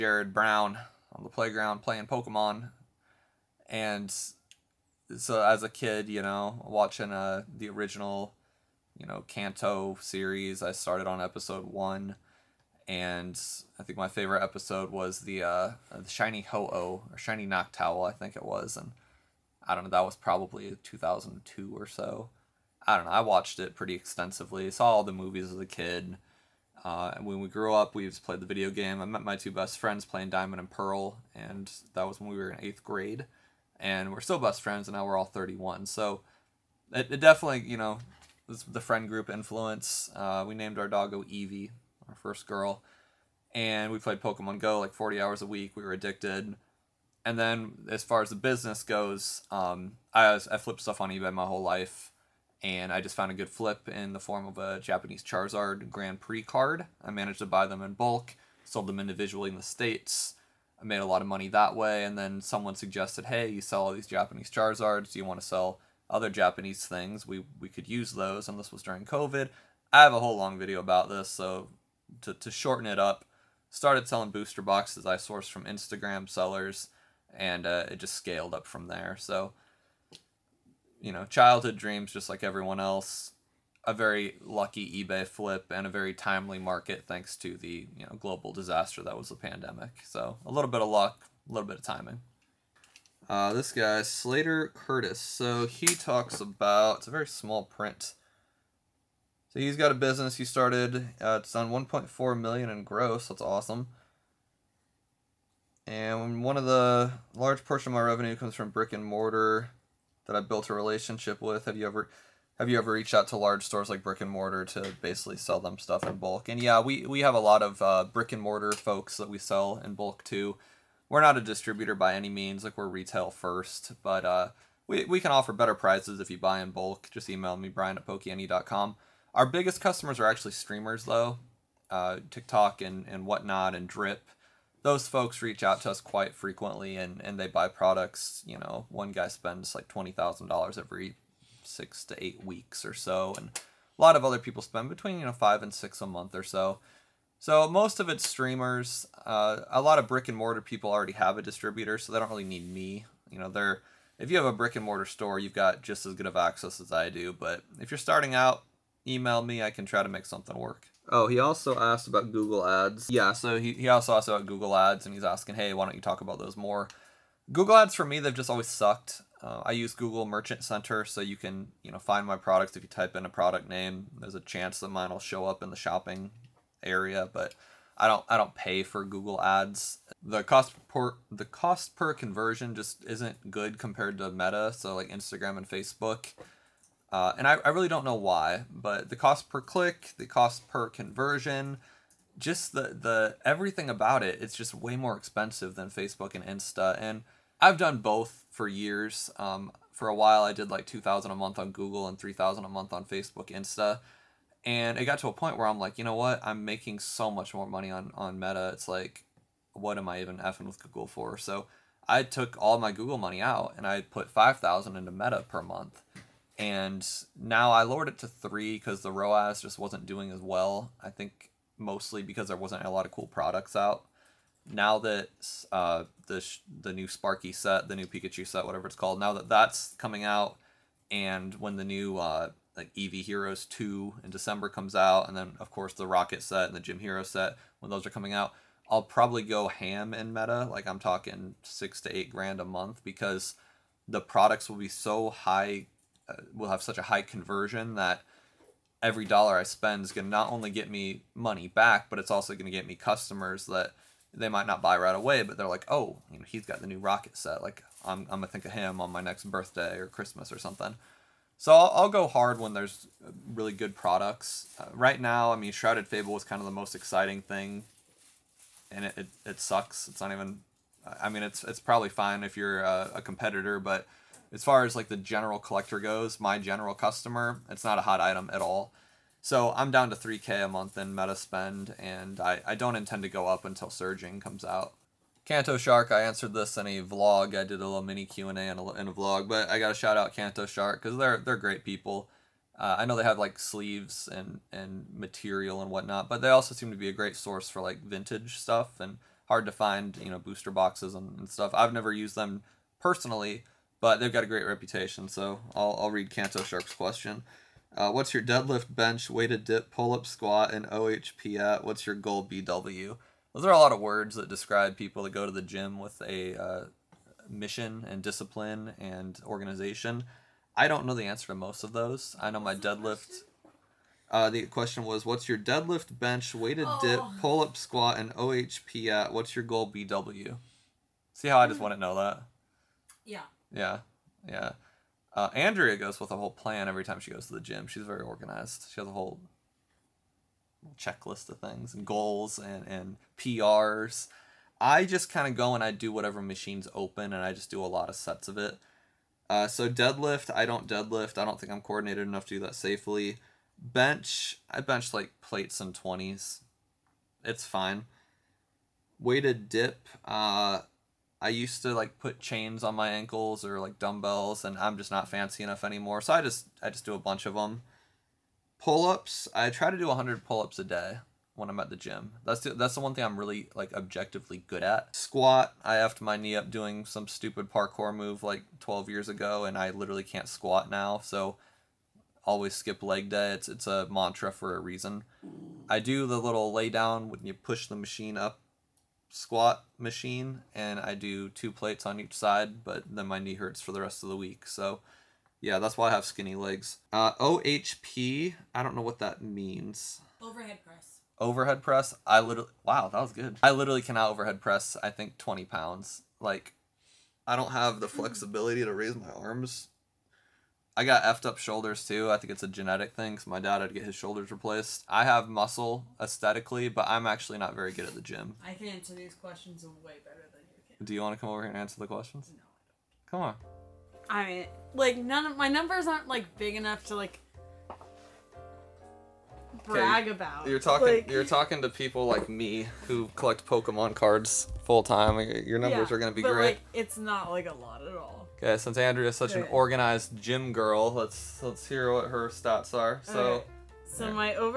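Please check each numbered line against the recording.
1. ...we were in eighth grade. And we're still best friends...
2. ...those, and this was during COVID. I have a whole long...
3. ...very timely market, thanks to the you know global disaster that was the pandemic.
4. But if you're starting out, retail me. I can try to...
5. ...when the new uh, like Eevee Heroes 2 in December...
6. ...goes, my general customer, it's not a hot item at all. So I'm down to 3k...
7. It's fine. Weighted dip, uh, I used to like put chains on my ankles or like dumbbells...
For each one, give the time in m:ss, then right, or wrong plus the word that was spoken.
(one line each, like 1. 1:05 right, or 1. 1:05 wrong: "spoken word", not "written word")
1. 0:32 right
2. 1:08 right
3. 1:25 right
4. 2:37 wrong: "email", not "retail"
5. 3:51 right
6. 4:35 right
7. 5:57 right.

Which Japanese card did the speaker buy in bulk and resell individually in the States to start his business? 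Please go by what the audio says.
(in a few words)
Japanese Charizard Grand Prix card.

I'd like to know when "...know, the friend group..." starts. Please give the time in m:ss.
0:37.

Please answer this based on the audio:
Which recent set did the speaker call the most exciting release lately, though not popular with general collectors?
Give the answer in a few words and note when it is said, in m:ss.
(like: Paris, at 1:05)
Shrouded Fable, at 4:25.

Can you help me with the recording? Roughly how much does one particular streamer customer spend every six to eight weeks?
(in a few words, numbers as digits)
$20,000.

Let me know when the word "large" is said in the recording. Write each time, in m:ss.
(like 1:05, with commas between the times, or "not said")
1:47, 1:53.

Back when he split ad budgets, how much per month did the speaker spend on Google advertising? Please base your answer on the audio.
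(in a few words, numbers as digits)
2,000.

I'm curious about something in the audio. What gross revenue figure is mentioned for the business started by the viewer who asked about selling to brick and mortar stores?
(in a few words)
1.4 million.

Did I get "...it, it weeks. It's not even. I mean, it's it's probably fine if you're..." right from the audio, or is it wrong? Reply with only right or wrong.
wrong.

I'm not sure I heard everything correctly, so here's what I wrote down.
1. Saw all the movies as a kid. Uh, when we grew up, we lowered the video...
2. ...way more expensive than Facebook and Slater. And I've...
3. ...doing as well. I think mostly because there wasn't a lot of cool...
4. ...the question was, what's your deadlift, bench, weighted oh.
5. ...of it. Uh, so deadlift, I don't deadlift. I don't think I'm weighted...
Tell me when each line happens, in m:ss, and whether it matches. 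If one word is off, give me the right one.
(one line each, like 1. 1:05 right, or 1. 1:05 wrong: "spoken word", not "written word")
1. 0:24 wrong: "played", not "lowered"
2. 3:14 wrong: "Insta", not "Slater"
3. 3:40 right
4. 5:24 right
5. 5:48 wrong: "coordinated", not "weighted".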